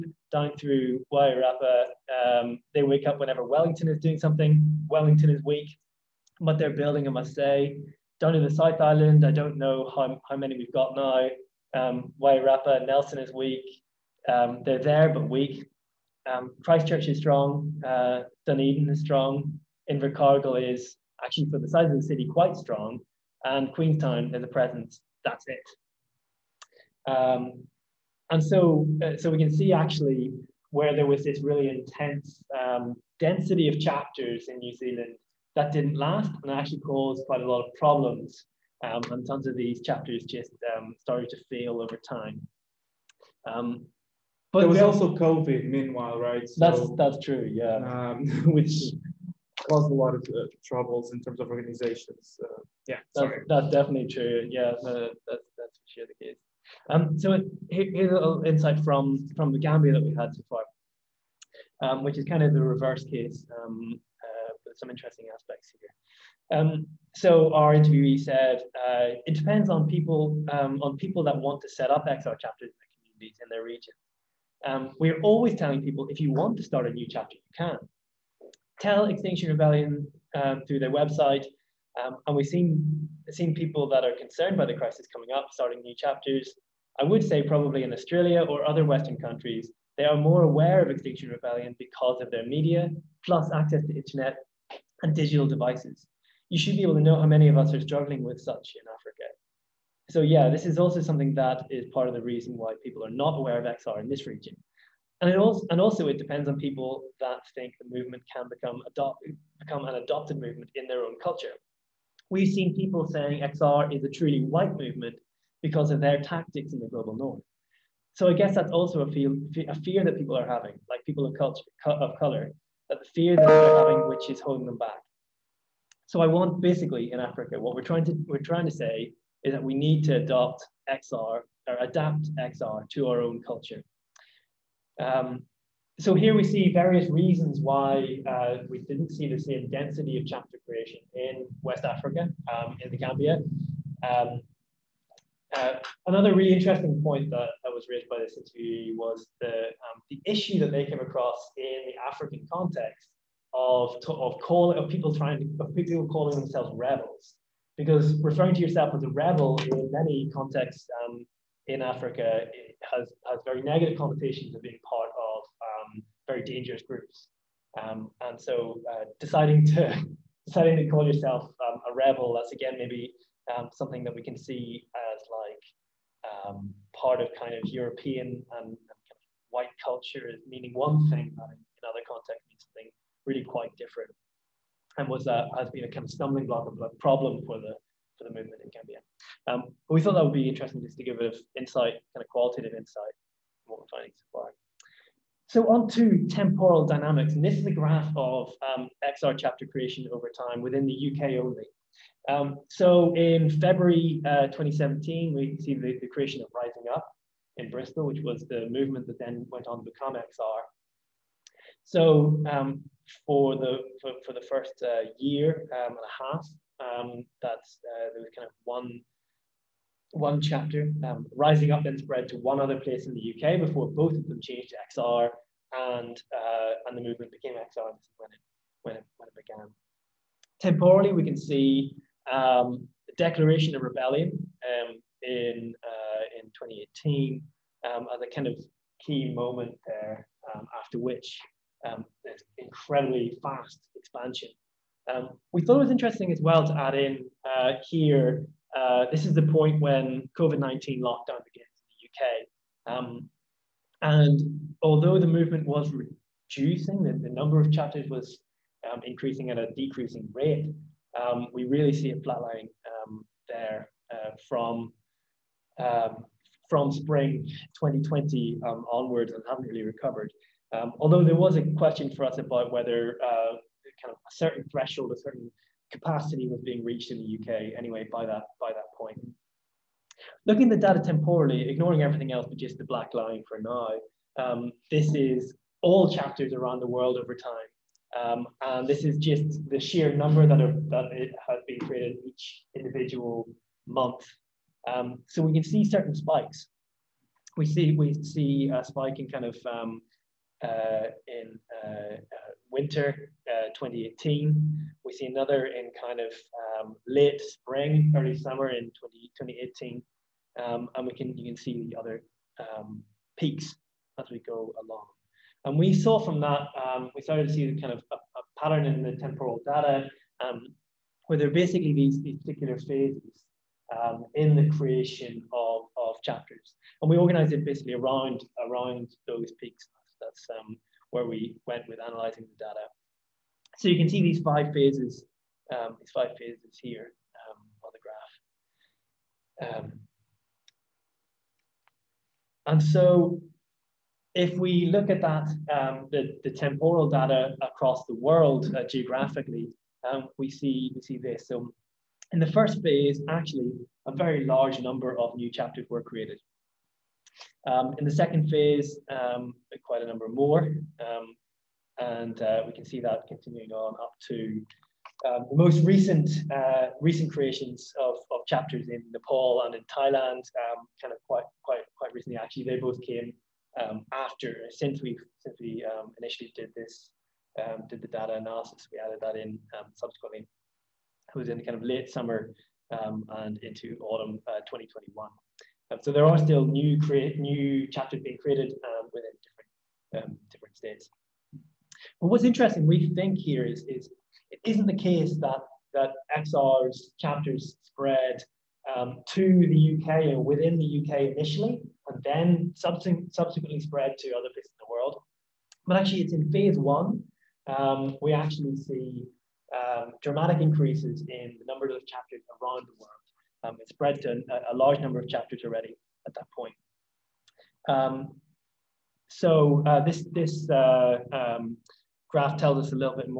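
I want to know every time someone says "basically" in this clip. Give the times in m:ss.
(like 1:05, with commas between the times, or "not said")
2:06, 5:21, 5:27.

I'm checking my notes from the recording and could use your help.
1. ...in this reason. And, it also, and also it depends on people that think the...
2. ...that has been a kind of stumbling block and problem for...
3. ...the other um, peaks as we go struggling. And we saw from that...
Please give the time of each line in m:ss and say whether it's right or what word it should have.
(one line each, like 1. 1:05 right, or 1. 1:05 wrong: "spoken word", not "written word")
1. 1:44 wrong: "region", not "reason"
2. 3:05 right
3. 5:11 wrong: "along", not "struggling".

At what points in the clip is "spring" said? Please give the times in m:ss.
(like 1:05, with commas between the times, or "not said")
4:26, 5:07.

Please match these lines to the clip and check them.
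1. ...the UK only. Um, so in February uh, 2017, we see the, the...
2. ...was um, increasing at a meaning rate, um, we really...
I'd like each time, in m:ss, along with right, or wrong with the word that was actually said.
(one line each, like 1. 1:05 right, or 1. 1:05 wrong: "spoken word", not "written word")
1. 3:20 right
2. 4:18 wrong: "decreasing", not "meaning".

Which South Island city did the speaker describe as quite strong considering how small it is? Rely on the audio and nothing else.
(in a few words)
Invercargill.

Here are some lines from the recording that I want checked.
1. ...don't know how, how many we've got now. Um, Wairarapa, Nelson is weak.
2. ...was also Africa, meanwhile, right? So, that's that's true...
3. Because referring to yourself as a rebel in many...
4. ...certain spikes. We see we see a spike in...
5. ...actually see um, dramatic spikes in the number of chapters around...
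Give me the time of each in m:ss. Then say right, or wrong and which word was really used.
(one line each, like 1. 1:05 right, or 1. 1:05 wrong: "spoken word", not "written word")
1. 0:09 right
2. 0:44 wrong: "COVID", not "Africa"
3. 2:37 right
4. 4:55 right
5. 6:48 wrong: "increases", not "spikes".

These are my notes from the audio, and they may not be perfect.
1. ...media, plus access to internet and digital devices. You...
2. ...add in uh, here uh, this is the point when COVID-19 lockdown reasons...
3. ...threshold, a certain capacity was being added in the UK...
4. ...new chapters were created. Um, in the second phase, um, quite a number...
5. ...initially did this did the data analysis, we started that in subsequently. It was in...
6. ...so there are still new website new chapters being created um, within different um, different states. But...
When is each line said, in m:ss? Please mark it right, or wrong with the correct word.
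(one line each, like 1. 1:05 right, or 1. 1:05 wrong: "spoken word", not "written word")
1. 1:32 right
2. 4:06 wrong: "begins", not "reasons"
3. 4:34 wrong: "reached", not "added"
4. 5:55 right
5. 6:16 wrong: "added", not "started"
6. 6:26 wrong: "create", not "website".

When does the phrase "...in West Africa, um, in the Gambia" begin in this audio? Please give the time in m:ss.
2:21.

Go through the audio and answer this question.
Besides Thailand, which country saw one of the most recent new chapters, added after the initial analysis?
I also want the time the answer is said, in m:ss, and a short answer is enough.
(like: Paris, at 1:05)
Nepal, at 6:09.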